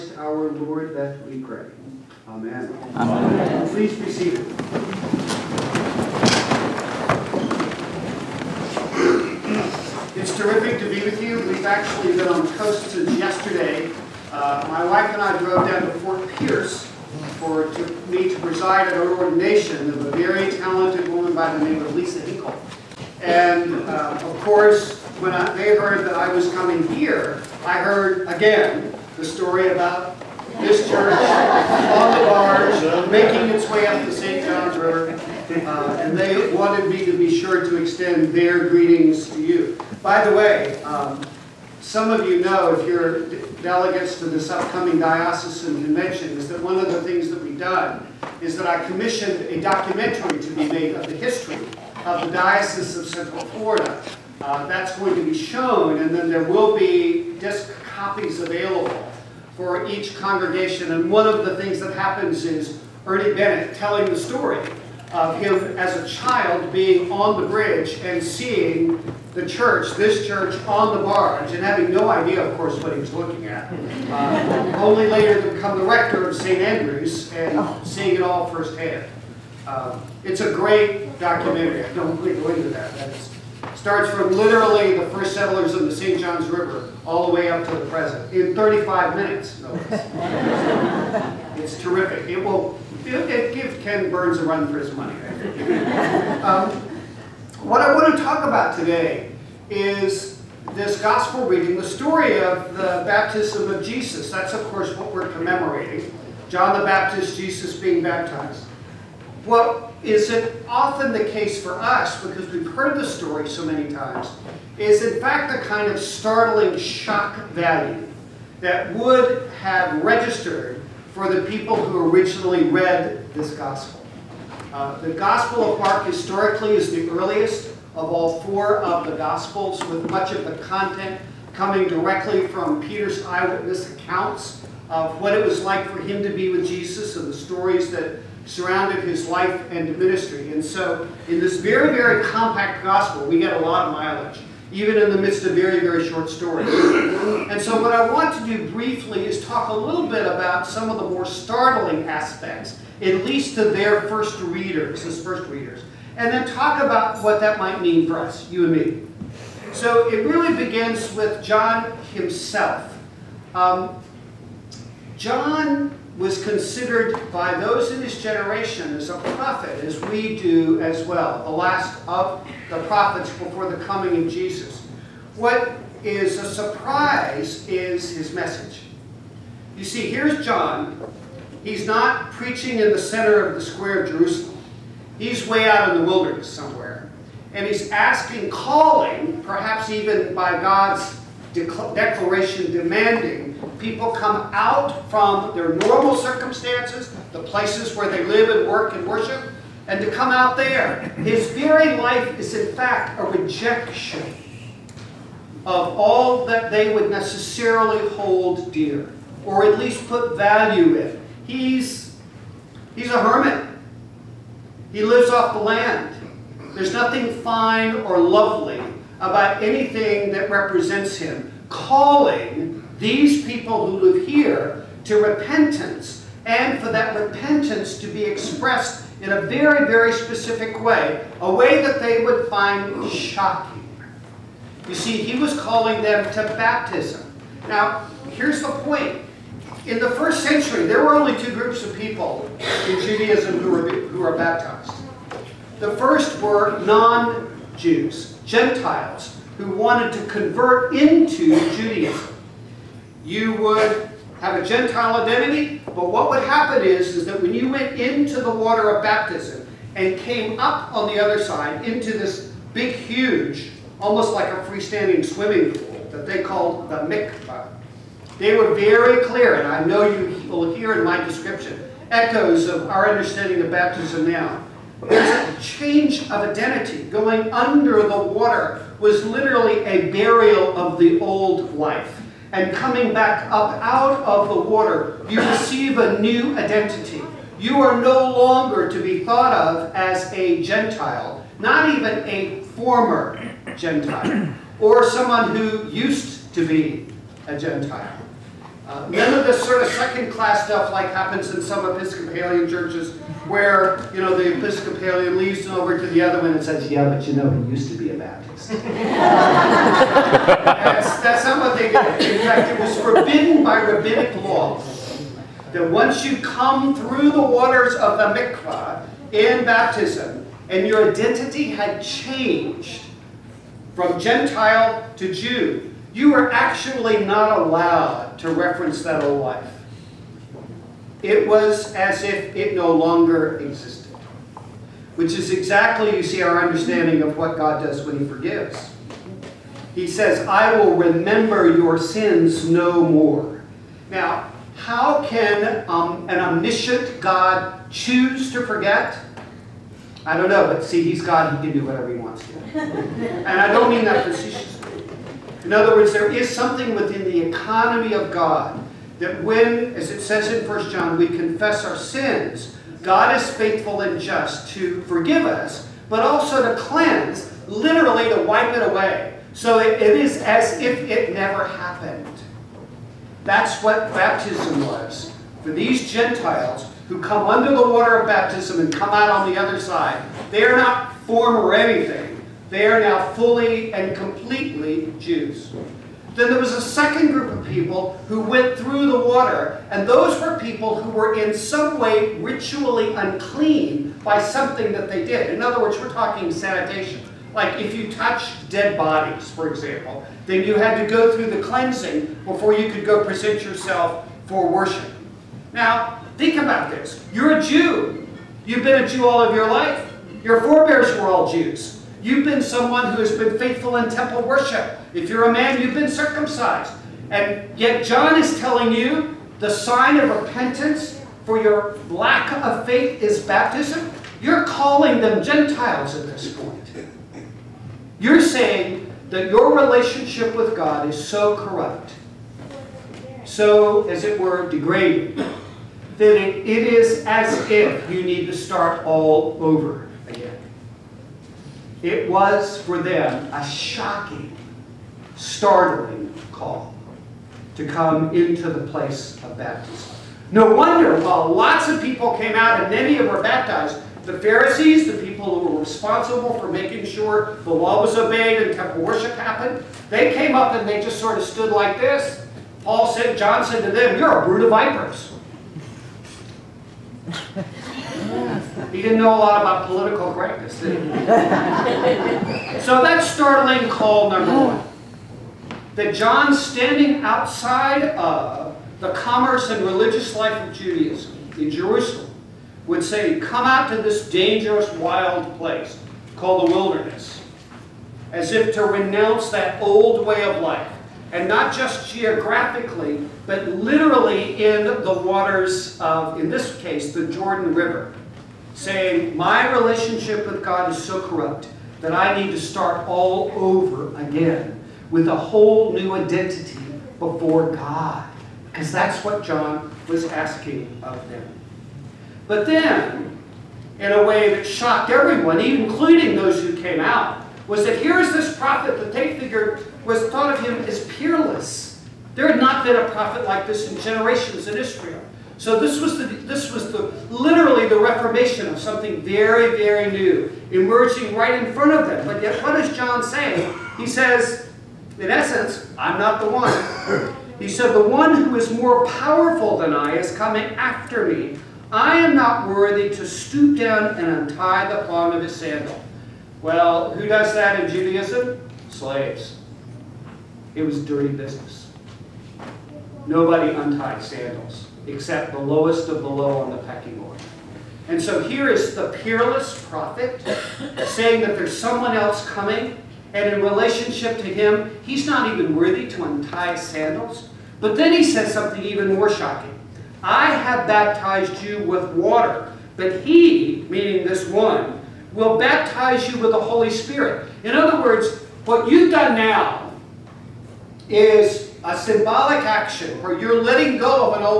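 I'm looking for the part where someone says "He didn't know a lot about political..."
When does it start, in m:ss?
7:48.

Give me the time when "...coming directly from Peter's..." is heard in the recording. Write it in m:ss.
2:11.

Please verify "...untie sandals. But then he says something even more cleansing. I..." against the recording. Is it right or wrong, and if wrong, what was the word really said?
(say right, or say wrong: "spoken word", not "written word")
wrong: "shocking", not "cleansing".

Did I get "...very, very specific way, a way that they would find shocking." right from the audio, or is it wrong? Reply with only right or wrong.
right.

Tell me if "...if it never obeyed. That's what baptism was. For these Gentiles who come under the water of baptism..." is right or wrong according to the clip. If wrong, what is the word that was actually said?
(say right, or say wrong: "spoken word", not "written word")
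wrong: "happened", not "obeyed".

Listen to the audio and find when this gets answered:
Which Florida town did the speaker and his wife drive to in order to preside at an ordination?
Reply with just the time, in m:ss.
0:16.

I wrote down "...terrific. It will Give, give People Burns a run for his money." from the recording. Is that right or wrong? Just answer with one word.
wrong.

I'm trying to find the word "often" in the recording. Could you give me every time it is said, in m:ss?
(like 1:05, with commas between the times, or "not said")
1:50.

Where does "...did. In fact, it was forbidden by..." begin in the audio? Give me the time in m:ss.
5:11.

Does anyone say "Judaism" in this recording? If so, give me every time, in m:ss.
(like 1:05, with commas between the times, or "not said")
4:03, 4:11, 8:00, 9:07.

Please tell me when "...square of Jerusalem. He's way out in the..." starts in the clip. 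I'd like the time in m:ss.
3:03.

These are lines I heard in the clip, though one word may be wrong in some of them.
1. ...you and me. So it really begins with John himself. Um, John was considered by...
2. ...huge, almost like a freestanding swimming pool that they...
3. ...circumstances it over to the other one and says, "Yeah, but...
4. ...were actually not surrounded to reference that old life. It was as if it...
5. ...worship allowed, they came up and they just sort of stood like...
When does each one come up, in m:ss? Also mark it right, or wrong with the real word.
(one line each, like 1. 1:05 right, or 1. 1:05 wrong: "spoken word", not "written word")
1. 2:38 right
2. 4:22 right
3. 5:05 wrong: "leaves", not "circumstances"
4. 5:26 wrong: "allowed", not "surrounded"
5. 7:39 wrong: "happened", not "allowed".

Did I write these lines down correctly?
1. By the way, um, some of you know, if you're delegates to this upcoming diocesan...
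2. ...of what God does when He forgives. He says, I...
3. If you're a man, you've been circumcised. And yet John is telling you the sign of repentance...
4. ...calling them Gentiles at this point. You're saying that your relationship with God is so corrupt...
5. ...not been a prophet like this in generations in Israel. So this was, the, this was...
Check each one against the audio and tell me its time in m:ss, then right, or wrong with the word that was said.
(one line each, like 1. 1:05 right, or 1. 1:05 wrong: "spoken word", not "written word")
1. 0:40 right
2. 5:37 right
3. 6:55 right
4. 7:04 right
5. 8:42 right.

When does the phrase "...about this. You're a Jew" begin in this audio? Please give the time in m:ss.
6:46.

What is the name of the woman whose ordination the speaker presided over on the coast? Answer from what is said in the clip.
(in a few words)
Lisa Hinkle.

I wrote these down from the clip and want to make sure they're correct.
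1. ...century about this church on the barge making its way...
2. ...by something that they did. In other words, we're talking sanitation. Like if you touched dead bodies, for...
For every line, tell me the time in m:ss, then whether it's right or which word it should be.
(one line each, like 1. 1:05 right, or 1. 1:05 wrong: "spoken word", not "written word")
1. 0:29 wrong: "story", not "century"
2. 6:34 right.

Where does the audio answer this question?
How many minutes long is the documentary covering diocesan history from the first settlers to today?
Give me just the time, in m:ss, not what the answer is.
1:28.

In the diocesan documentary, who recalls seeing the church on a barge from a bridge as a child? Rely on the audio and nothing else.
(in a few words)
Ernie Bennett.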